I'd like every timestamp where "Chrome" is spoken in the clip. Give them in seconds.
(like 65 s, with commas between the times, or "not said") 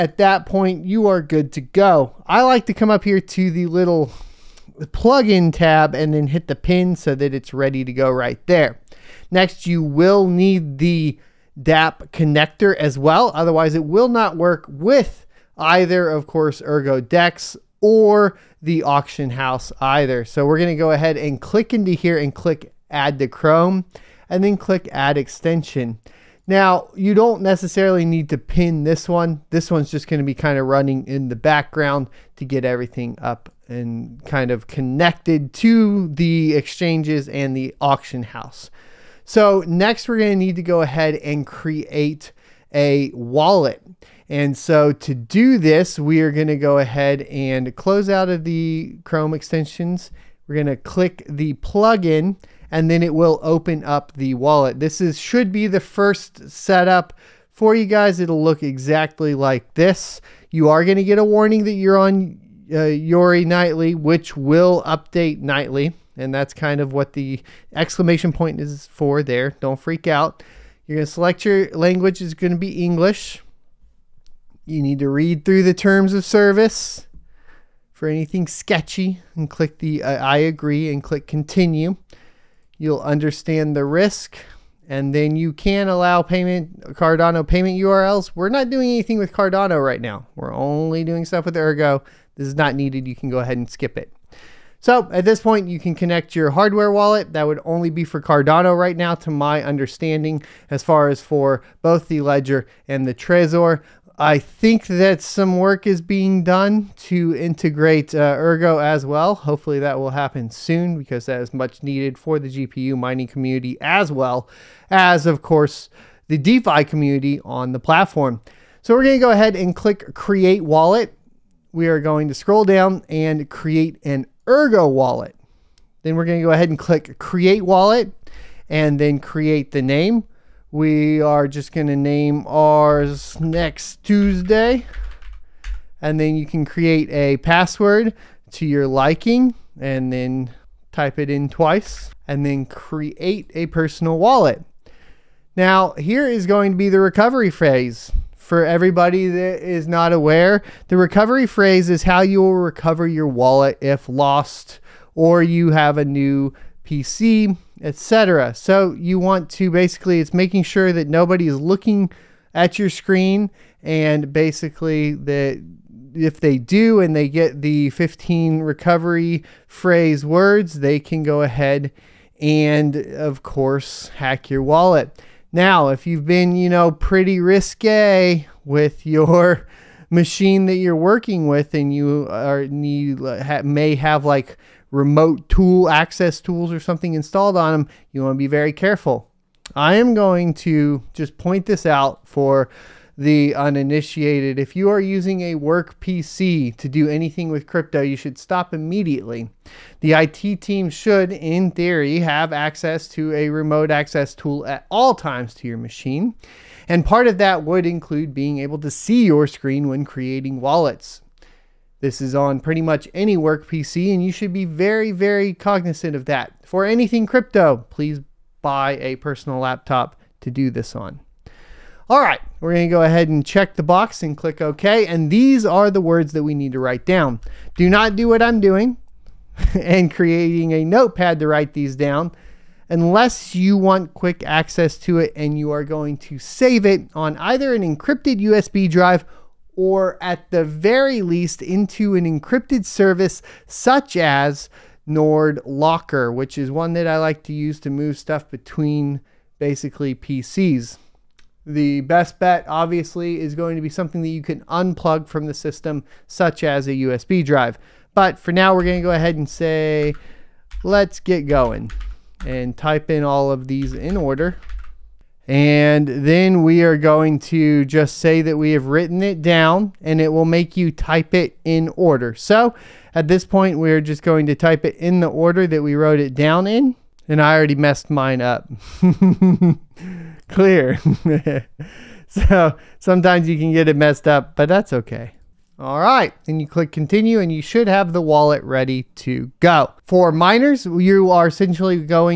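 23 s, 49 s.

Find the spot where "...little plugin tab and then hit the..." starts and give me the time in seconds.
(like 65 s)
3 s.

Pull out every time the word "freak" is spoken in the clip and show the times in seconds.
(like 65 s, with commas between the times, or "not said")
69 s.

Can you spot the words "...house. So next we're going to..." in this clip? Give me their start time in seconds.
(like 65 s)
38 s.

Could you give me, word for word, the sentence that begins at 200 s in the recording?
The IT team should, in theory, have access to a remote access tool at all times to your machine.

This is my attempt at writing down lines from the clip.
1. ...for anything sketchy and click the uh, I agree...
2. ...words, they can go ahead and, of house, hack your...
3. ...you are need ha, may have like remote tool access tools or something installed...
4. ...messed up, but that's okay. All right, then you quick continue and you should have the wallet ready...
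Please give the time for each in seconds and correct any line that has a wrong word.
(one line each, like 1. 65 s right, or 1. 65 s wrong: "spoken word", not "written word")
1. 77 s right
2. 170 s wrong: "course", not "house"
3. 181 s right
4. 283 s wrong: "click", not "quick".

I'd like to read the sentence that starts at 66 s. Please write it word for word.
And that's kind of what the exclamation point is for there.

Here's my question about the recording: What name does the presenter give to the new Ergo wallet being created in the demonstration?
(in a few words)
next Tuesday.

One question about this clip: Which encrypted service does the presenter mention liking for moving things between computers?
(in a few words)
Nord Locker.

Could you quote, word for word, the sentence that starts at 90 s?
We're only doing stuff with Ergo.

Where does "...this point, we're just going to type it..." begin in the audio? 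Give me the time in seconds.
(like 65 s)
273 s.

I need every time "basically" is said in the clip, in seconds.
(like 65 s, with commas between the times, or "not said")
159 s, 164 s, 249 s.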